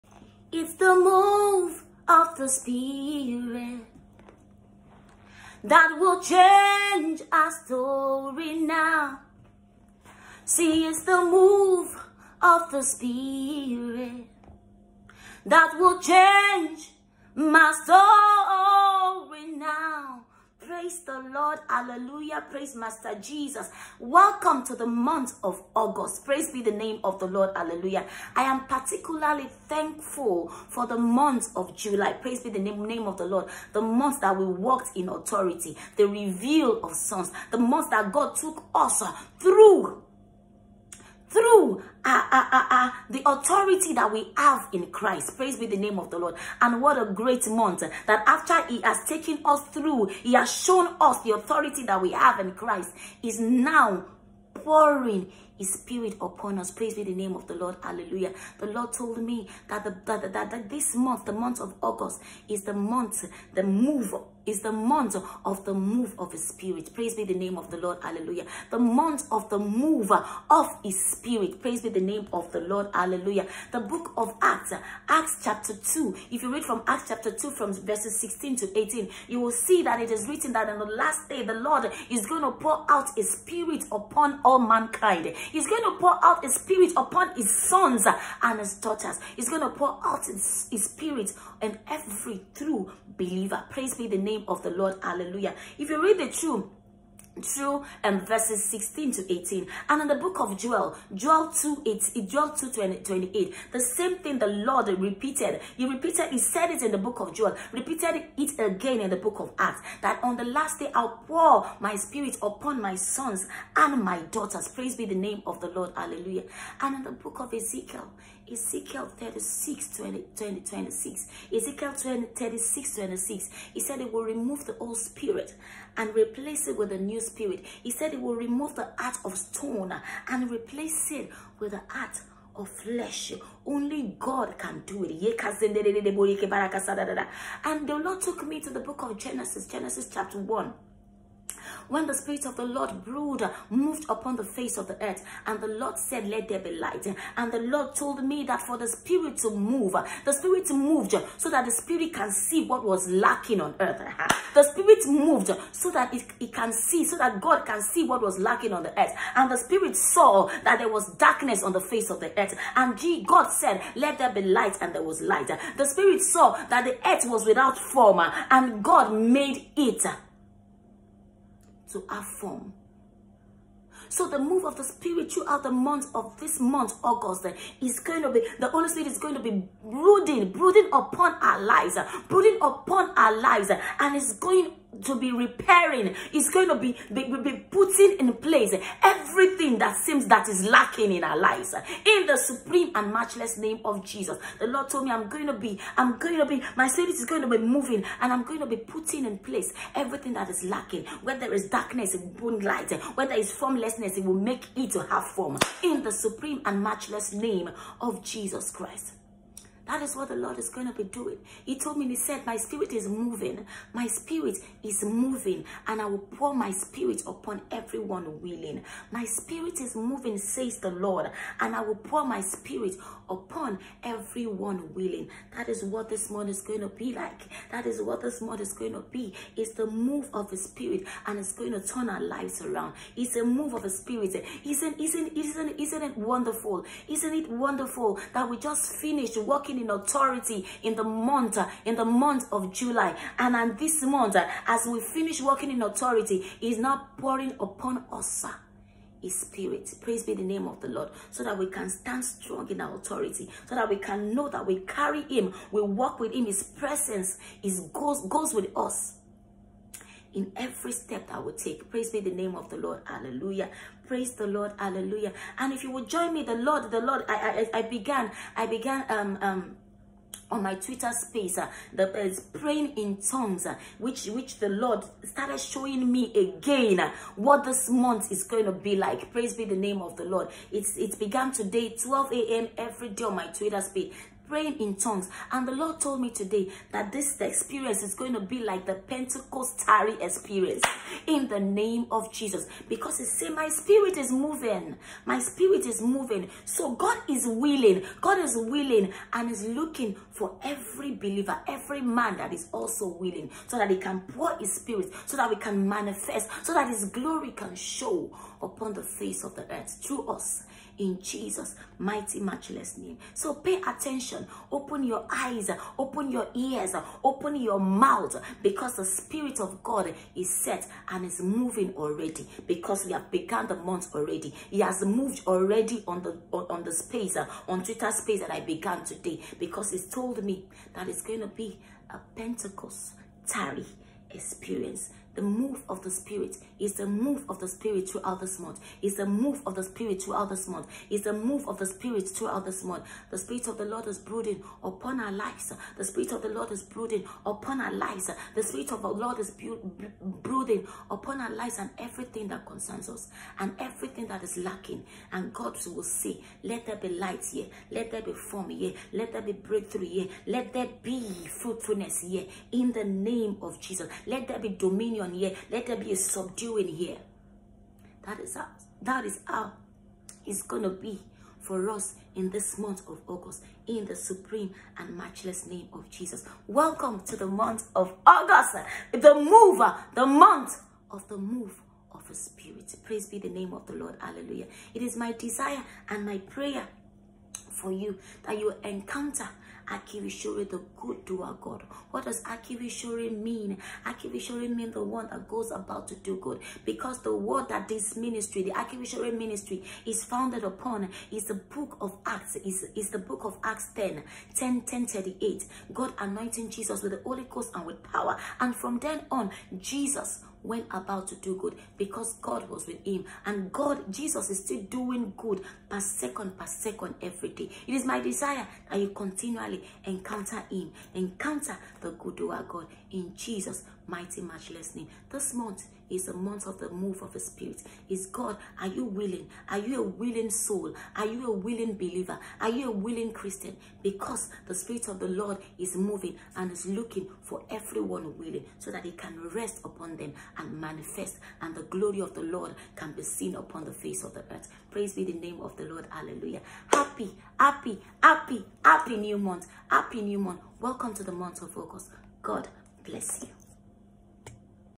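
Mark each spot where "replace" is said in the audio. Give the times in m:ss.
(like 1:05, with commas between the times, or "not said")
2:06, 2:10.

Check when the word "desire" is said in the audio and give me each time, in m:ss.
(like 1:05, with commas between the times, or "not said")
6:25, 6:58.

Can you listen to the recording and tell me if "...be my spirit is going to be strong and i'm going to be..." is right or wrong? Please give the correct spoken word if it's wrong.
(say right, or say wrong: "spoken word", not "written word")
wrong: "moving", not "strong".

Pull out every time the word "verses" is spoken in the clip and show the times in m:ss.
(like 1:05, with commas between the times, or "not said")
1:17, 1:38.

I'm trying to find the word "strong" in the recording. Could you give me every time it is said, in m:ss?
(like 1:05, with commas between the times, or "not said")
4:12.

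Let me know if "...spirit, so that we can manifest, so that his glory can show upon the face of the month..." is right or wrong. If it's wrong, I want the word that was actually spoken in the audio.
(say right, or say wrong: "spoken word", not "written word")
wrong: "earth", not "month".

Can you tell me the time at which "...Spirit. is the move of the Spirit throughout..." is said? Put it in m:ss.
5:36.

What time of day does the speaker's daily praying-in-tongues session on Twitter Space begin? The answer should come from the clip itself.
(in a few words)
12 a.m.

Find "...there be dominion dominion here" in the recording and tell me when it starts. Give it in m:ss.
6:04.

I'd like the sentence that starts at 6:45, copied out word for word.
God anointing Jesus with the Holy Ghost and with power.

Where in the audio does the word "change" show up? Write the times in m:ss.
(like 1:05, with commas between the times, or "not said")
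0:06, 0:16.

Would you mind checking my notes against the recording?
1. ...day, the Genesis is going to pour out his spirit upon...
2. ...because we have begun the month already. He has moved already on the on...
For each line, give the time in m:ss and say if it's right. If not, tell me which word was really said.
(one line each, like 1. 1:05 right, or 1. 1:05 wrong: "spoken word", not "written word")
1. 1:21 wrong: "Lord", not "Genesis"
2. 5:22 right.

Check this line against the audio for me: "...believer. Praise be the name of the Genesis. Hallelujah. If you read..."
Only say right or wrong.
wrong.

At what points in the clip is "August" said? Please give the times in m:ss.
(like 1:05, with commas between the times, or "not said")
0:25, 1:01, 2:57, 6:13, 6:18, 7:31.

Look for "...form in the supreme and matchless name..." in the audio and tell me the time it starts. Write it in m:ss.
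3:25.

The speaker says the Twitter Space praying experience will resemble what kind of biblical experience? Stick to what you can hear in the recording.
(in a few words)
Pentecostary experience.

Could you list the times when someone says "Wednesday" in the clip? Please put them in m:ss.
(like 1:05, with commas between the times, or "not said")
not said.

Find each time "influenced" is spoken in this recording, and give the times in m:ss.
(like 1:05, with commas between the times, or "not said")
not said.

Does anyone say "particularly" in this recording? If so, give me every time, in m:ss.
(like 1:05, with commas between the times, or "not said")
0:28.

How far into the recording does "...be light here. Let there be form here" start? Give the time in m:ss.
5:56.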